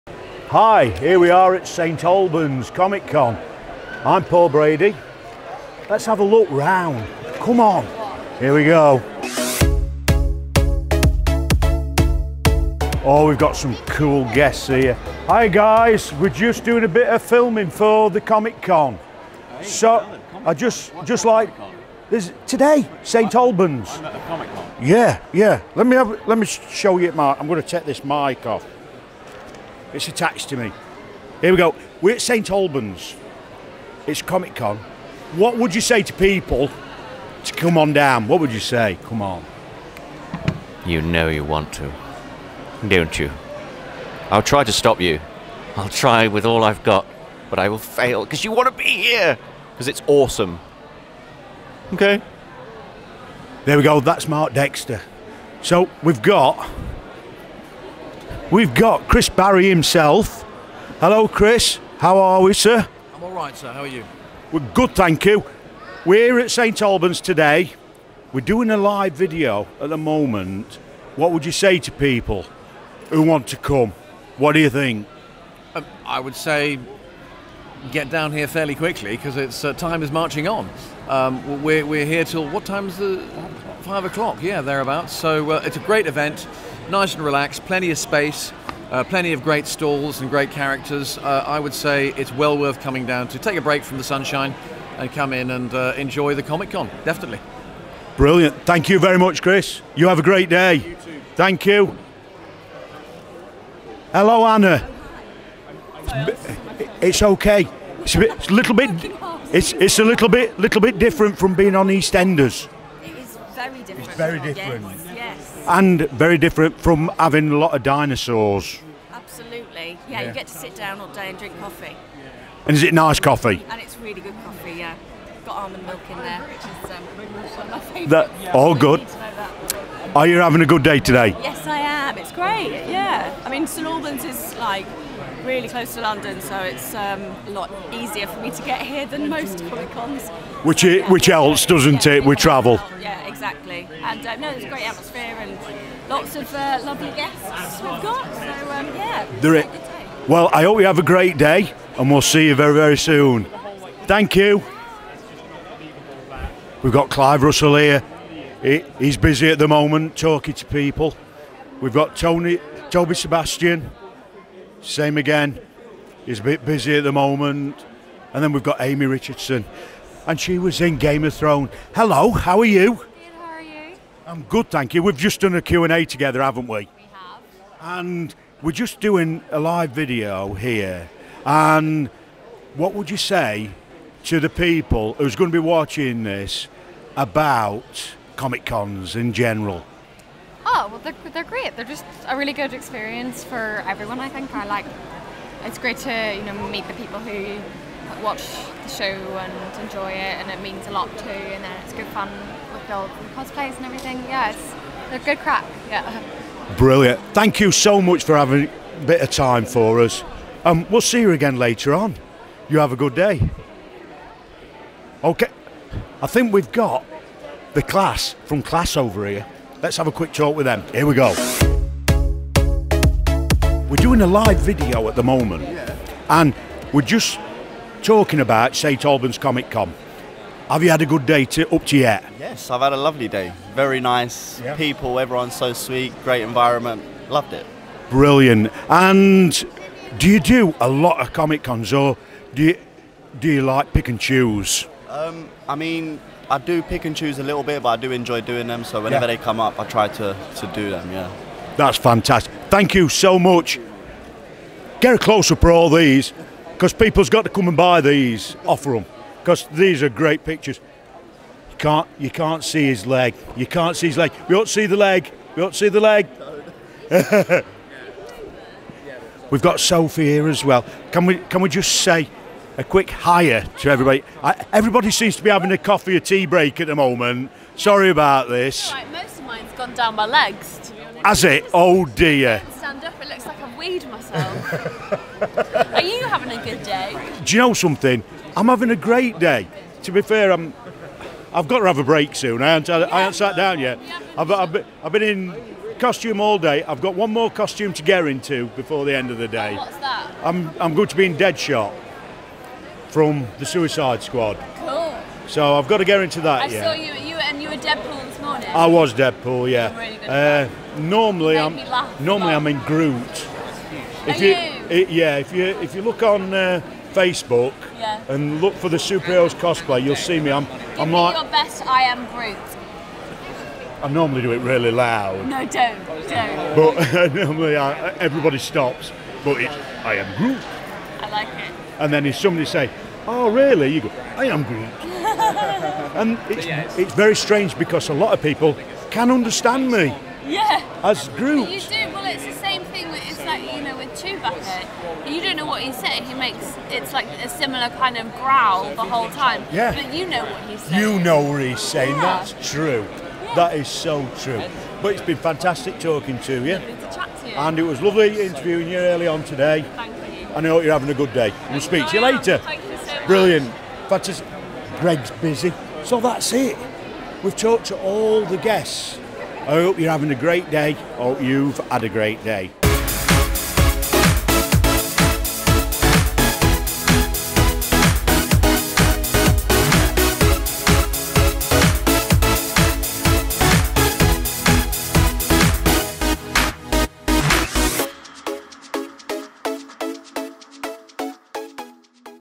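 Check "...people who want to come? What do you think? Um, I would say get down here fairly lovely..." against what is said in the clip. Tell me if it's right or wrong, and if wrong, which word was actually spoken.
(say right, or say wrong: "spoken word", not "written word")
wrong: "quickly", not "lovely".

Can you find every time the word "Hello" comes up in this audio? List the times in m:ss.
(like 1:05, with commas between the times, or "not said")
1:00, 1:44, 2:51.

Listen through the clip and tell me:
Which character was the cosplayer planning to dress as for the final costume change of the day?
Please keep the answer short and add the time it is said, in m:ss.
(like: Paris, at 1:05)
Deadshot, at 5:01.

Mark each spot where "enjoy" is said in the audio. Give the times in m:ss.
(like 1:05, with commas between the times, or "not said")
1:35, 3:19, 4:08.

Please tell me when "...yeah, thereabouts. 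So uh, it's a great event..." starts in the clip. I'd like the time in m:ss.
1:24.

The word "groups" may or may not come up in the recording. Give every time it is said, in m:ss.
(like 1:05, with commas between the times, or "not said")
5:41.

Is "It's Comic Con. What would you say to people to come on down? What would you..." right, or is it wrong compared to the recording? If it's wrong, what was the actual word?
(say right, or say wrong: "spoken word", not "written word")
right.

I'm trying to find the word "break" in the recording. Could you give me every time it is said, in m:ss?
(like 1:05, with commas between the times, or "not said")
1:33, 4:36, 4:52.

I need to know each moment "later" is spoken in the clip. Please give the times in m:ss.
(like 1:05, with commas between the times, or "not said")
3:31, 6:02.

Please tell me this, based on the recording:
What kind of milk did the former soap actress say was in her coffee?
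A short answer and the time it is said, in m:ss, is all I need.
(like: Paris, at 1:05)
Almond milk, at 2:05.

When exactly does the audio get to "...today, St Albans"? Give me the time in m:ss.
0:22.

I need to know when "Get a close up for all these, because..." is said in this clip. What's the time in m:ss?
4:15.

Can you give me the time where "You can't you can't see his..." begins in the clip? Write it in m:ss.
4:21.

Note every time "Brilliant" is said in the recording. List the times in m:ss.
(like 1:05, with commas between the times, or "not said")
1:38, 3:26, 3:58, 6:03.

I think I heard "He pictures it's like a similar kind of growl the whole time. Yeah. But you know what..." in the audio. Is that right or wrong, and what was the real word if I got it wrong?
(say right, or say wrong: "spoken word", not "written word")
wrong: "makes", not "pictures".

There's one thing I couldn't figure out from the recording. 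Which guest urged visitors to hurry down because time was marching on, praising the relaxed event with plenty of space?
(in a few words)
Chris Barrie.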